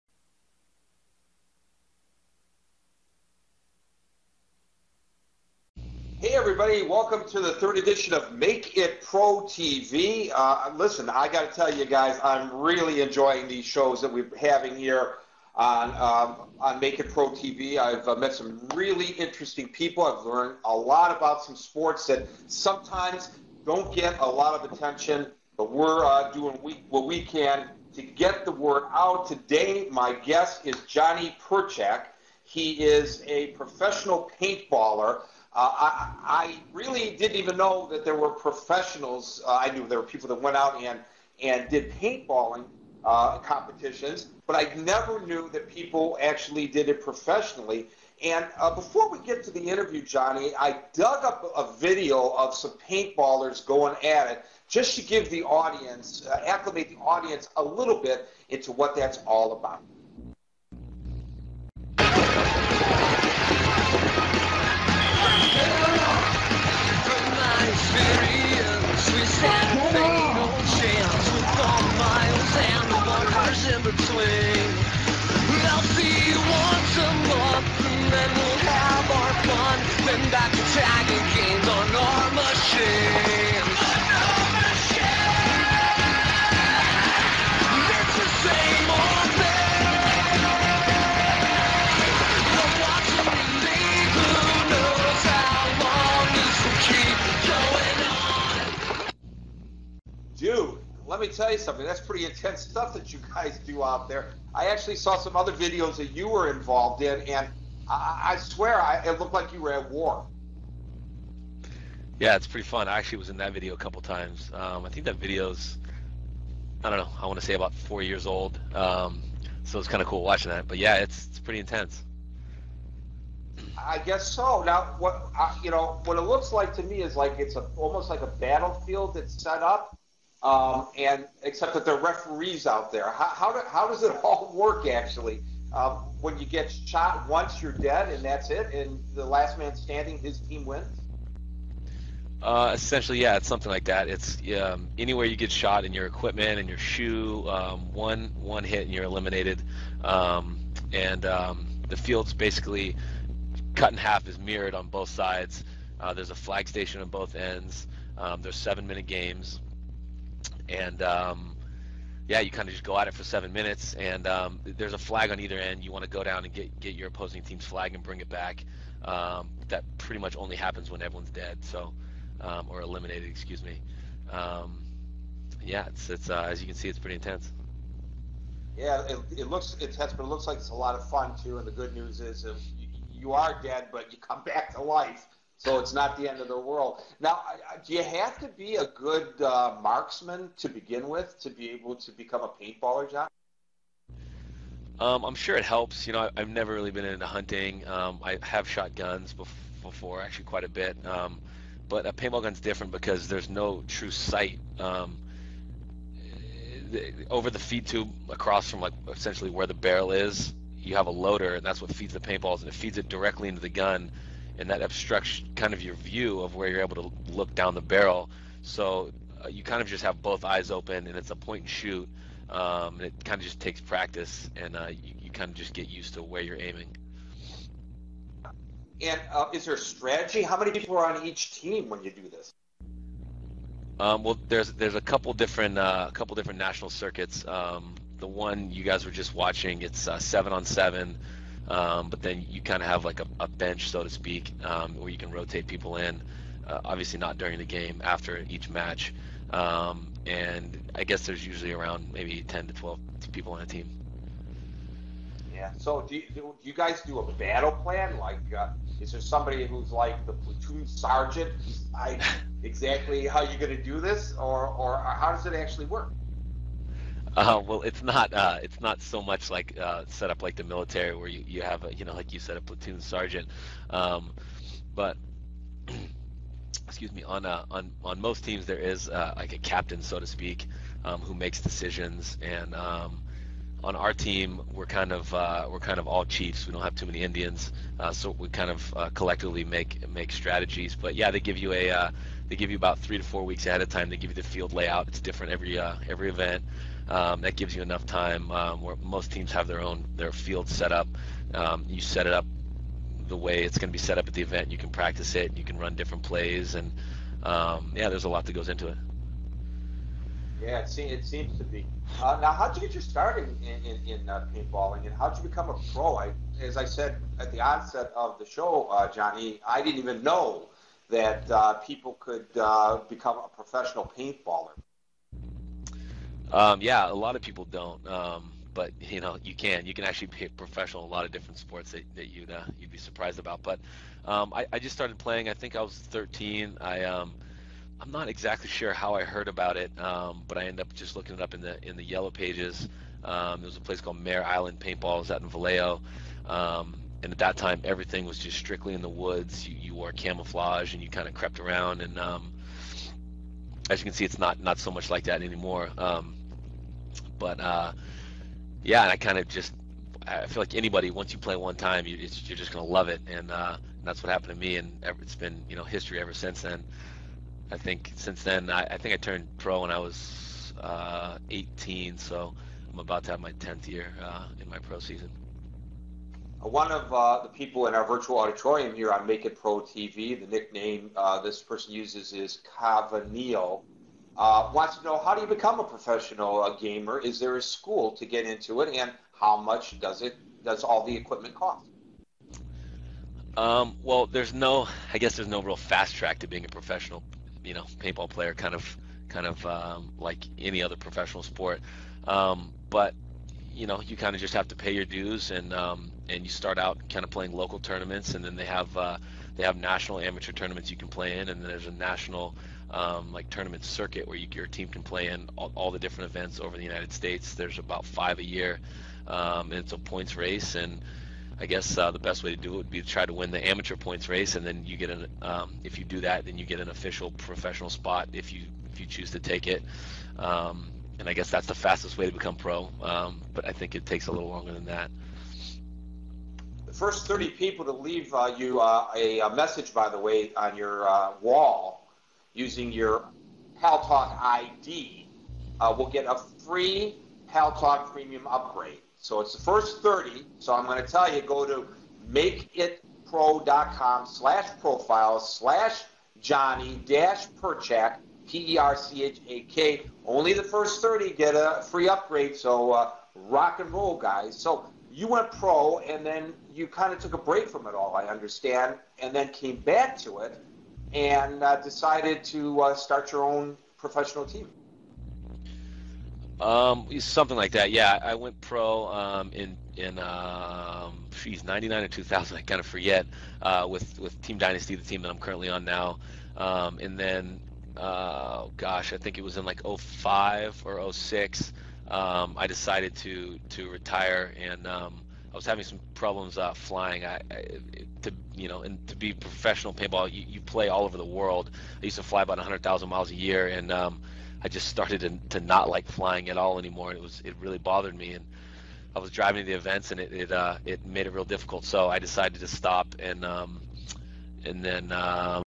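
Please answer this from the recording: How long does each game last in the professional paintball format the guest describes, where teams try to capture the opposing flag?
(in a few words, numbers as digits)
7 minutes.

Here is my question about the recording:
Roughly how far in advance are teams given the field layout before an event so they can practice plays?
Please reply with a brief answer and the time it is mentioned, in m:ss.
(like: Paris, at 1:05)
3 to 4 weeks, at 4:52.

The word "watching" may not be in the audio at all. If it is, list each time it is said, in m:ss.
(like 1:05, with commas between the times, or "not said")
2:00, 3:59.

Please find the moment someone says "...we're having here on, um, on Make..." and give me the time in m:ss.
0:14.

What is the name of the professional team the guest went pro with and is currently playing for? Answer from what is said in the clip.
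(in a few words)
Team Dynasty.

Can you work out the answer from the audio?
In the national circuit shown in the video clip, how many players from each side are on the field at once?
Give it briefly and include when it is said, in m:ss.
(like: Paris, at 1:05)
7 on 7, at 4:00.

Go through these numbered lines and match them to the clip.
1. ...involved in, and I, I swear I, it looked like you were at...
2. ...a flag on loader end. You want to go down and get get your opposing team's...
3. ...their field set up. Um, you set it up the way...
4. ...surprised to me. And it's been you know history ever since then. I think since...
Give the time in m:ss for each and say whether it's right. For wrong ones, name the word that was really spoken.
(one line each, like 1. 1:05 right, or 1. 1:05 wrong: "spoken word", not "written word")
1. 1:46 right
2. 2:44 wrong: "either", not "loader"
3. 5:00 right
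4. 6:04 wrong: "happened", not "surprised".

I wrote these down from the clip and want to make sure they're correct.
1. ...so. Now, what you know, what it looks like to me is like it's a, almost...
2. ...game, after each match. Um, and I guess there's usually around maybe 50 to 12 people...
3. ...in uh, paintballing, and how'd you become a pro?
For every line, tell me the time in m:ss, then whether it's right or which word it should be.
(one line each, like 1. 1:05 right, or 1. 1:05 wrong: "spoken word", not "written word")
1. 2:04 right
2. 4:07 wrong: "10", not "50"
3. 5:14 right.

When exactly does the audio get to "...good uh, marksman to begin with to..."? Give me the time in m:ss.
3:08.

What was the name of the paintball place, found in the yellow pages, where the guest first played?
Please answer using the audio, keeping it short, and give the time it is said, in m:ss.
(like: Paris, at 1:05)
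Mare Island Paintball, at 5:44.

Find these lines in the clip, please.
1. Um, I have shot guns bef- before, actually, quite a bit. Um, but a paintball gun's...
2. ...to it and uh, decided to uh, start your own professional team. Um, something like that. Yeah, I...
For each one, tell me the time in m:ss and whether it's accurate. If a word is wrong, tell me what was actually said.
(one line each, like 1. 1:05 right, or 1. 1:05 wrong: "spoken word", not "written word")
1. 3:17 right
2. 7:50 right.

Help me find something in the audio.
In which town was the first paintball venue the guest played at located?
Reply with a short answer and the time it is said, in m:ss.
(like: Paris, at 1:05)
Vallejo, at 5:45.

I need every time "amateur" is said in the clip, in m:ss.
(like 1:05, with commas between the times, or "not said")
6:50, 7:03.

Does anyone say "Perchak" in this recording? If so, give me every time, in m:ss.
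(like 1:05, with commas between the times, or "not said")
0:31, 7:37.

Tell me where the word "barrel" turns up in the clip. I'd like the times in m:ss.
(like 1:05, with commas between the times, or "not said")
3:29, 3:37.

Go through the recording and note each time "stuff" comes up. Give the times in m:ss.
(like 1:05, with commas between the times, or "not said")
1:42.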